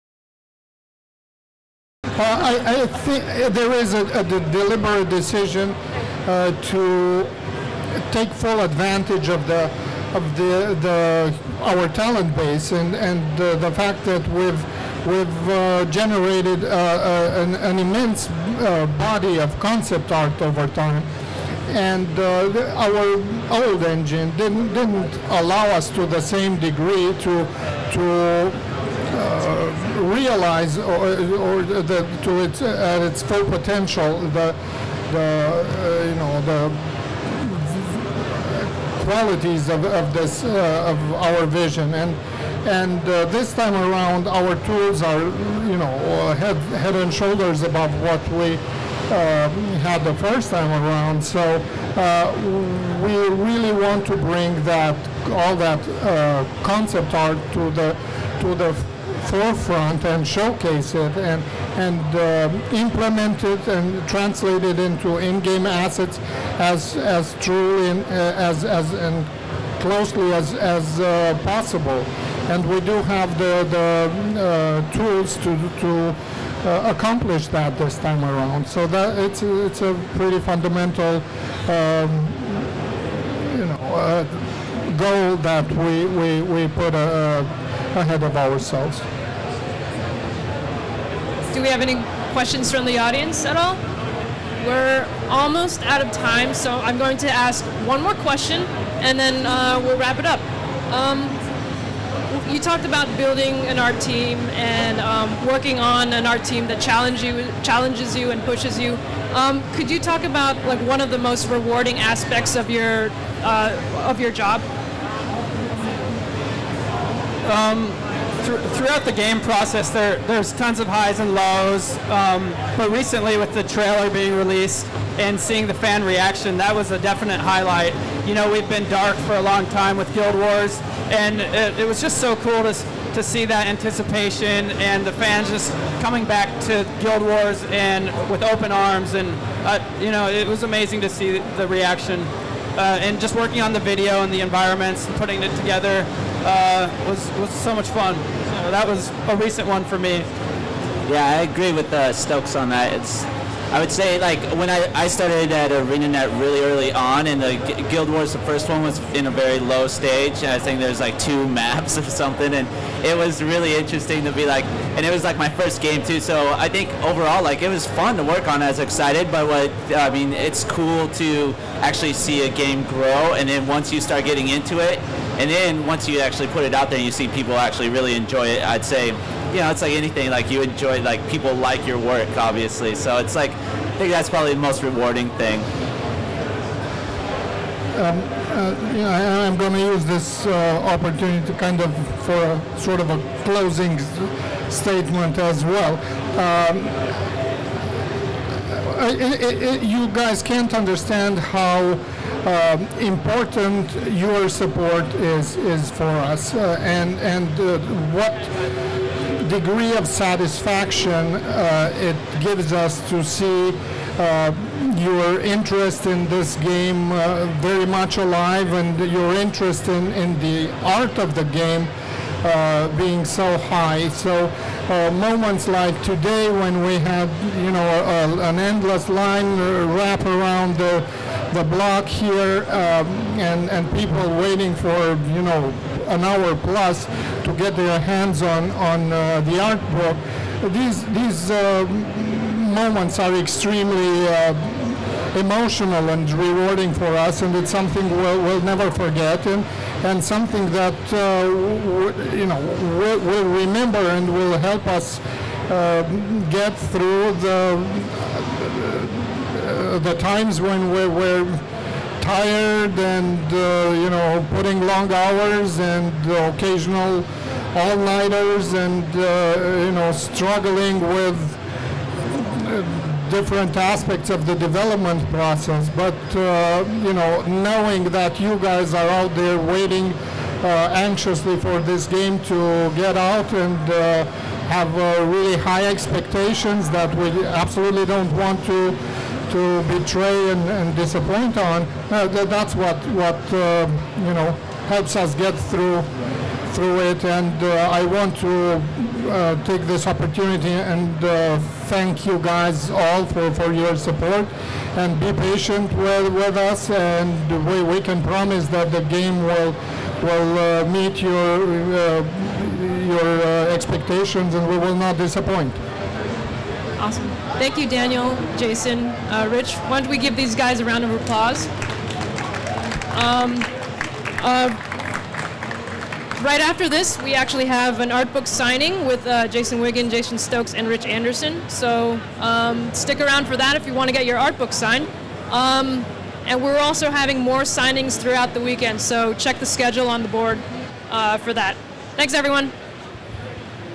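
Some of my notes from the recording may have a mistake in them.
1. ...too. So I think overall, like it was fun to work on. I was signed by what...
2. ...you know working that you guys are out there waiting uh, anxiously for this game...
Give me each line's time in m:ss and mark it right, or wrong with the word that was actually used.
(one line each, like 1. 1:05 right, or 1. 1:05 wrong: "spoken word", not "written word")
1. 2:46 wrong: "excited", not "signed"
2. 4:37 wrong: "knowing", not "working".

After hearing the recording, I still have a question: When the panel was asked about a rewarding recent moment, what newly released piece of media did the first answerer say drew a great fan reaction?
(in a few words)
the trailer.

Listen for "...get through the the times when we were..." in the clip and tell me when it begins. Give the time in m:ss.
4:16.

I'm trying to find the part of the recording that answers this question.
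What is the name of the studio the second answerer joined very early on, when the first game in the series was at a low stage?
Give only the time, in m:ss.
2:35.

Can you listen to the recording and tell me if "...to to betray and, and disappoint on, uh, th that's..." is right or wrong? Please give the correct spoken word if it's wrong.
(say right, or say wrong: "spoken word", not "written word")
right.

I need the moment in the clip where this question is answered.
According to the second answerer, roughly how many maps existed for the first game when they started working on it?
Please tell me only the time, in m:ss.
2:41.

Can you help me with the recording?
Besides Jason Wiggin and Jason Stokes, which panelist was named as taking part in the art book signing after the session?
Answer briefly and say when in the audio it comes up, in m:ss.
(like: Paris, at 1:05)
Rich Anderson, at 5:30.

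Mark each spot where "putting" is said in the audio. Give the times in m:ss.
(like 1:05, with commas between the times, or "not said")
2:25, 4:24.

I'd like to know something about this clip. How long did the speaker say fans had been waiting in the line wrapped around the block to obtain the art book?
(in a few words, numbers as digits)
an hour plus.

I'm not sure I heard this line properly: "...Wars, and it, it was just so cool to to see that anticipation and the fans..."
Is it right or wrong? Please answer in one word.
right.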